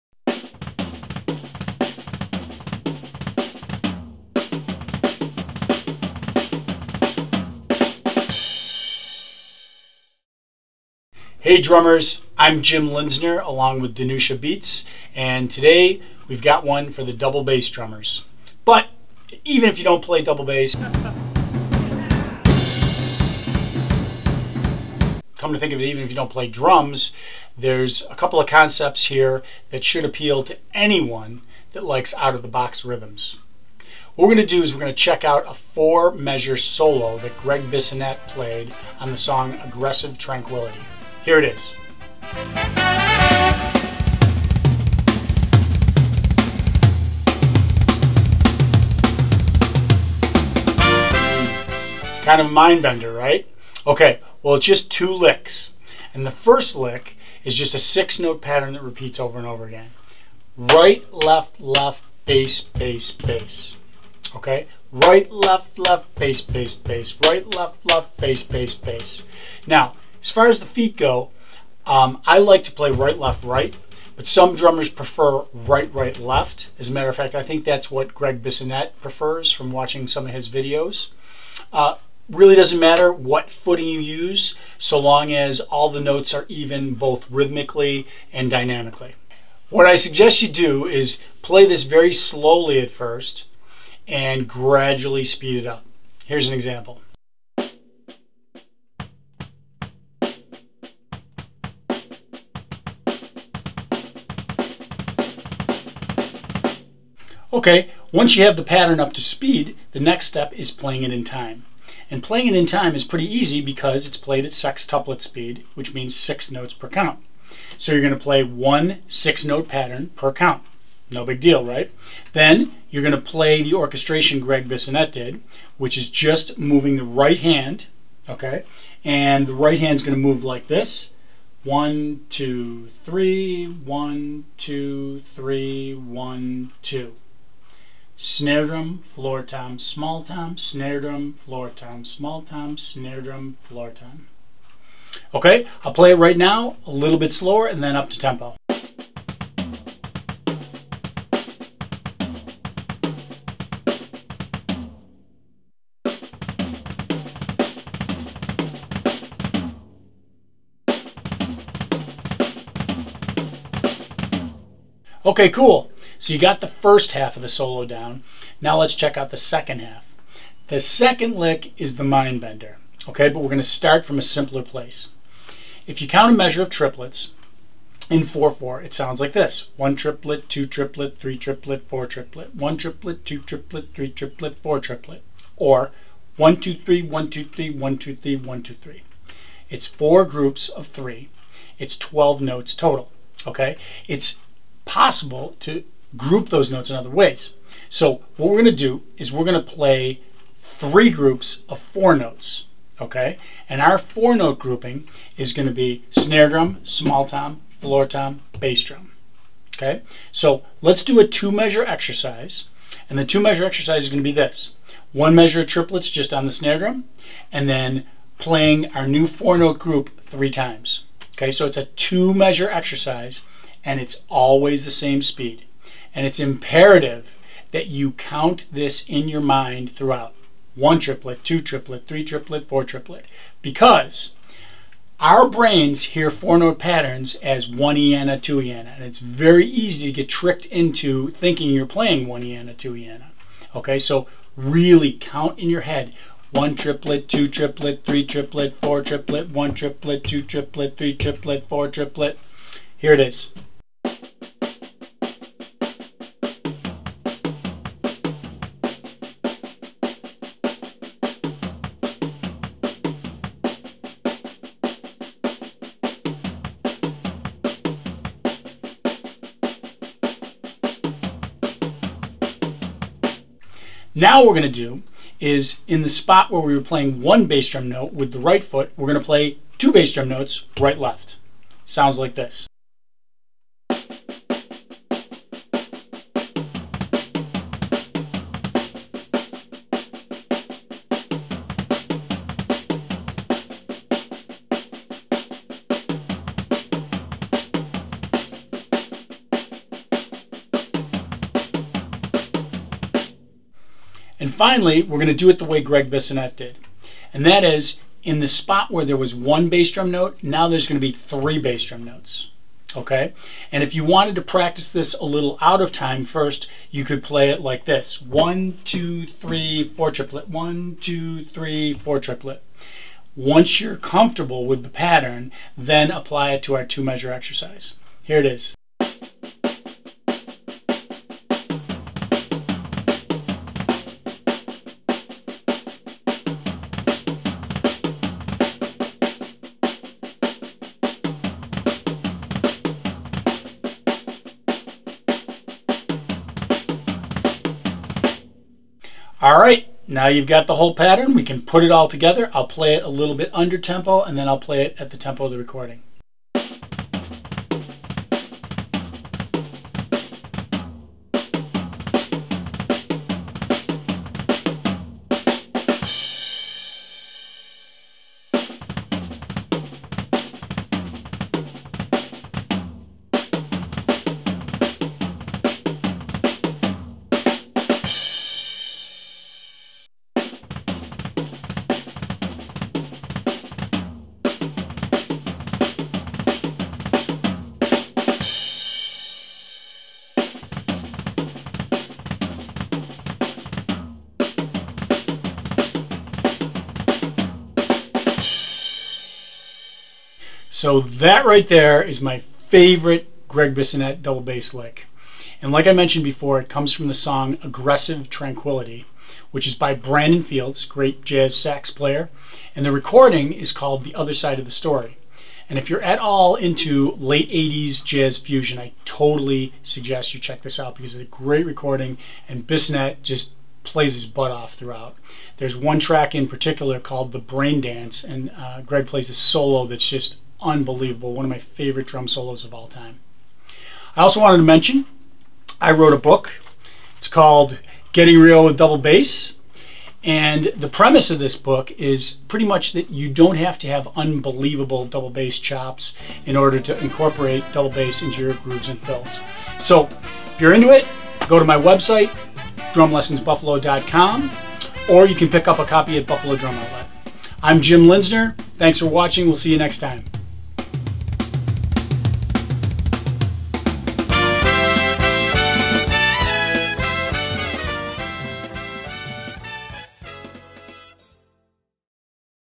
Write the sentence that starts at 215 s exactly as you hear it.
One measure of triplets just on the snare drum, and then playing our new four note group three times.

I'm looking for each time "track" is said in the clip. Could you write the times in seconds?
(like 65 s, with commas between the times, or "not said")
425 s.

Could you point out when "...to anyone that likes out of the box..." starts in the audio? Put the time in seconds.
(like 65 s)
30 s.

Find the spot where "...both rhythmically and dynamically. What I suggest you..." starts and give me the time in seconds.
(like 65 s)
86 s.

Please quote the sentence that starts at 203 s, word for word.
And our four note grouping is going to be snare drum, small tom, floor tom, bass drum, okay?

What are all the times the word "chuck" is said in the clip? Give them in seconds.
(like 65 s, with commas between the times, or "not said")
not said.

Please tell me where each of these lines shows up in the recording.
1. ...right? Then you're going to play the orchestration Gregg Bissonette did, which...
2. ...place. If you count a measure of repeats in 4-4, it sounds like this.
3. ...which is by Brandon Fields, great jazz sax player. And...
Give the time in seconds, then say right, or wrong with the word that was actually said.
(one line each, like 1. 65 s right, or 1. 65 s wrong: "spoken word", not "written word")
1. 121 s right
2. 174 s wrong: "triplets", not "repeats"
3. 409 s right.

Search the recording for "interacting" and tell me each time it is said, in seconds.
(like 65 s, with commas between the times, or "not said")
not said.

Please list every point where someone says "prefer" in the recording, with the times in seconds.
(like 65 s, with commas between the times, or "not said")
74 s, 79 s.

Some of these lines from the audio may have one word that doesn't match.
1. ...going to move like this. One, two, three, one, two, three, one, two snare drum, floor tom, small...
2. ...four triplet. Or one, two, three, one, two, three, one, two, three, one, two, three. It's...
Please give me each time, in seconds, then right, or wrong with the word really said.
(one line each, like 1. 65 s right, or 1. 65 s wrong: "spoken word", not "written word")
1. 130 s right
2. 184 s right.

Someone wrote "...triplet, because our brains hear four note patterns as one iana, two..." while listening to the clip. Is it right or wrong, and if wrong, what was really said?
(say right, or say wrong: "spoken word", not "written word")
right.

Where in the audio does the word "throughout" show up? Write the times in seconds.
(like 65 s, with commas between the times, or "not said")
229 s, 424 s.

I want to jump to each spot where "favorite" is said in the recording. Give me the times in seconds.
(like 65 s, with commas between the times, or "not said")
402 s, 431 s.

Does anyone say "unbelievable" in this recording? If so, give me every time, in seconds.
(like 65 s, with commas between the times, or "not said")
430 s, 444 s.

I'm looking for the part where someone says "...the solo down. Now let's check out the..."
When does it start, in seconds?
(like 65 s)
167 s.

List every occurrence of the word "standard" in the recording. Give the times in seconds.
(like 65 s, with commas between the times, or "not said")
not said.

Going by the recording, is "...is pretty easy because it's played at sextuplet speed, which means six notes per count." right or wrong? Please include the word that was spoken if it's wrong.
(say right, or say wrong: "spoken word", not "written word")
right.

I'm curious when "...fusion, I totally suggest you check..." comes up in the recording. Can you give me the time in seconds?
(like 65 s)
418 s.